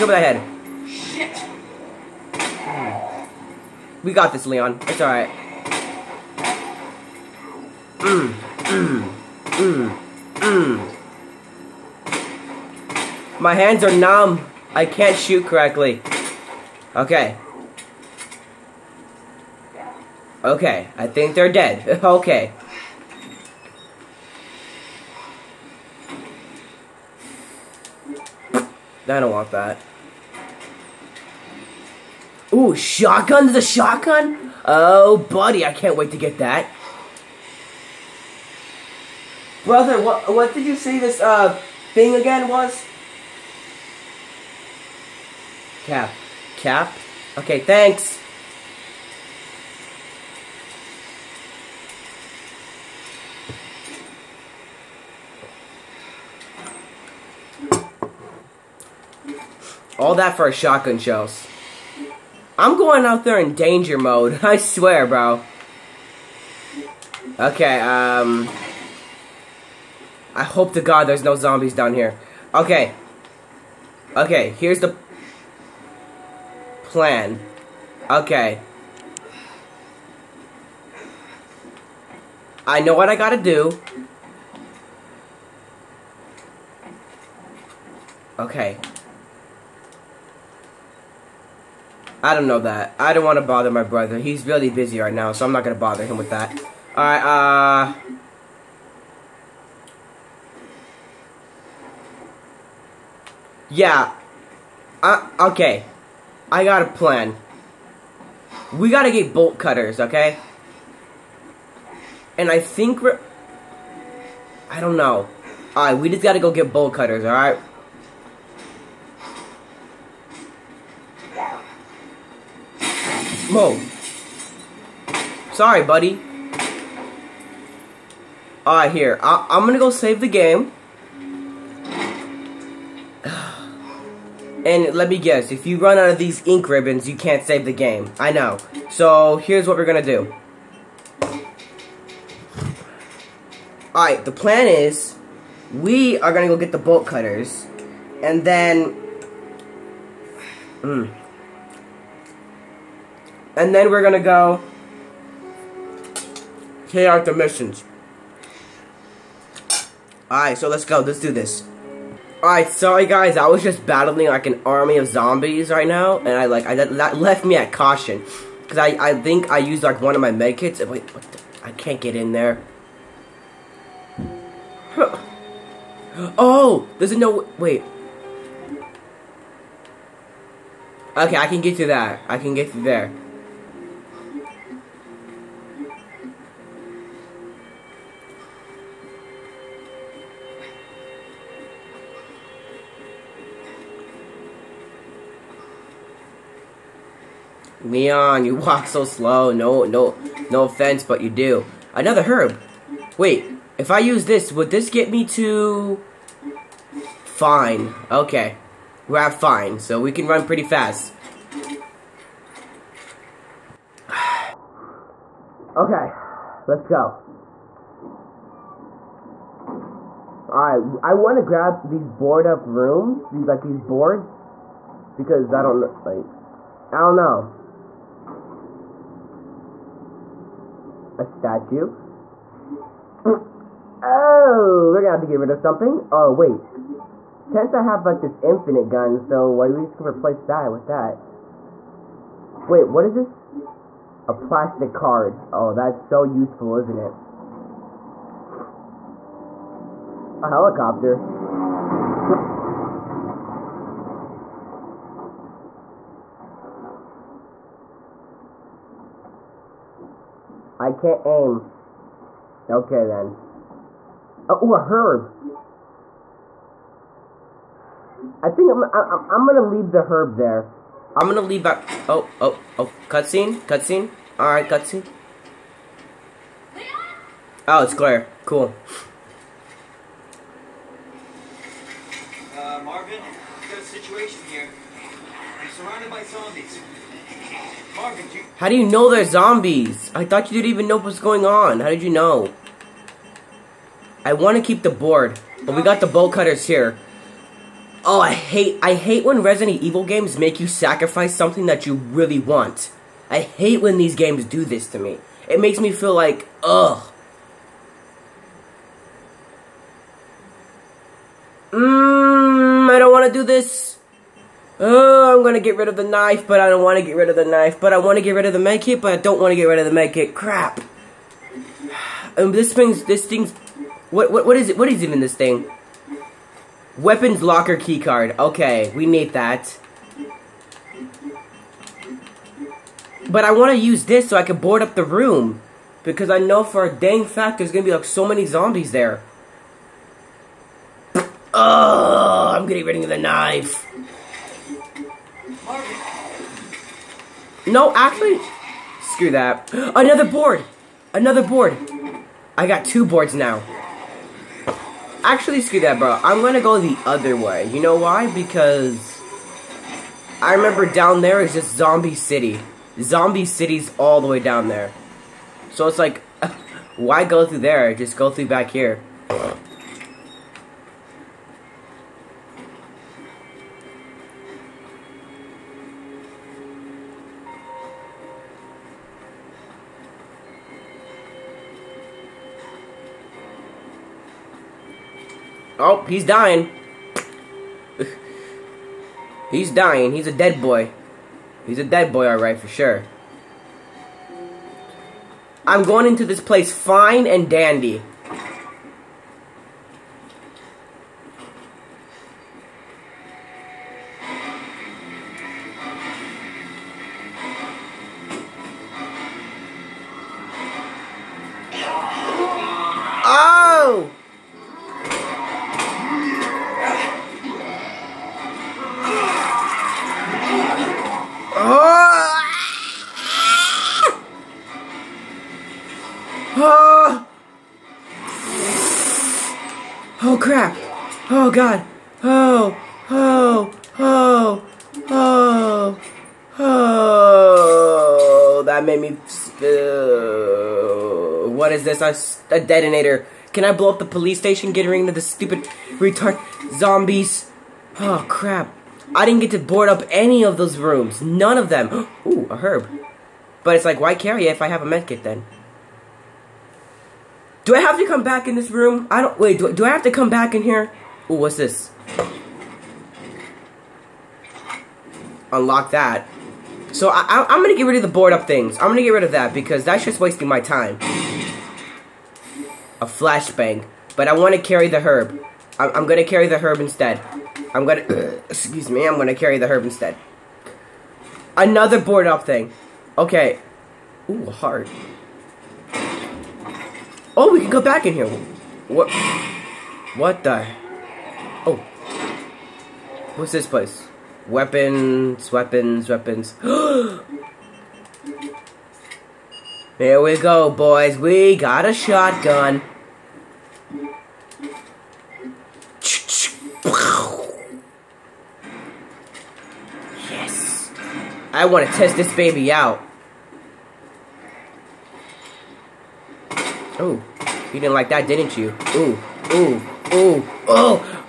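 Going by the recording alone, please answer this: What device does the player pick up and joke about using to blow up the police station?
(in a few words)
A detonator.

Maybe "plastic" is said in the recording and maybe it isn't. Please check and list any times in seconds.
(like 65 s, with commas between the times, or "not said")
244 s.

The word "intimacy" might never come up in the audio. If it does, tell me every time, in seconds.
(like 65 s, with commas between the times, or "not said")
not said.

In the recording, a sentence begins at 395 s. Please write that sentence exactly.
I'm going into this place fine and dandy.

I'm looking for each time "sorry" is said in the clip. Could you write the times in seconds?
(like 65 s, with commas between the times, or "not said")
125 s, 162 s.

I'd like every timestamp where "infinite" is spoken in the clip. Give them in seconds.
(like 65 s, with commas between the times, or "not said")
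238 s.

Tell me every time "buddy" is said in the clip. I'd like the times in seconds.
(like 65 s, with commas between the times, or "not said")
35 s, 125 s.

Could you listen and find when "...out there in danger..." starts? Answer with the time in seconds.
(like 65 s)
63 s.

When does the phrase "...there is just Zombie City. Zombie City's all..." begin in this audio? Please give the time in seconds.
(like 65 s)
361 s.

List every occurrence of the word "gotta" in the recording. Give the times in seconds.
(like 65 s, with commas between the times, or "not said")
83 s, 108 s, 116 s.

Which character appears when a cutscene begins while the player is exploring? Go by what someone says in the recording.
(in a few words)
Claire.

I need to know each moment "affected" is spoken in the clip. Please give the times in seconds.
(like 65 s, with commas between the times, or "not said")
not said.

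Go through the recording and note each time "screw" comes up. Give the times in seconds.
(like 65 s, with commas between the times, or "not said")
349 s, 355 s.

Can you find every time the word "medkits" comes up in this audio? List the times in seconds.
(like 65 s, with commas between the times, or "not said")
170 s, 454 s.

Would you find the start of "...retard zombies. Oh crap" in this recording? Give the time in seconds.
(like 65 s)
445 s.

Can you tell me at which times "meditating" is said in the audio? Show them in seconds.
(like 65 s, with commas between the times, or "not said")
not said.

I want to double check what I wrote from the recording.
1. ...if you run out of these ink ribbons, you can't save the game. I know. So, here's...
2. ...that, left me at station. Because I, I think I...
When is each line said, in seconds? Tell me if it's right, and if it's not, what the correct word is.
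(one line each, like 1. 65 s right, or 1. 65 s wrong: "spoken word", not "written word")
1. 135 s right
2. 166 s wrong: "caution", not "station".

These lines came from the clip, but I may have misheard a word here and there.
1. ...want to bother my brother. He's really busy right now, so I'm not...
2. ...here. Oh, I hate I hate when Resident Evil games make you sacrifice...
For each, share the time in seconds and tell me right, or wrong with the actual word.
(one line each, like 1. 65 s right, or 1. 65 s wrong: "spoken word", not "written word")
1. 93 s right
2. 296 s right.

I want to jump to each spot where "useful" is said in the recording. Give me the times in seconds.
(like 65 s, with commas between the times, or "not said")
246 s.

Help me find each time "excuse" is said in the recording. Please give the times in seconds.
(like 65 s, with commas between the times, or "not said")
478 s.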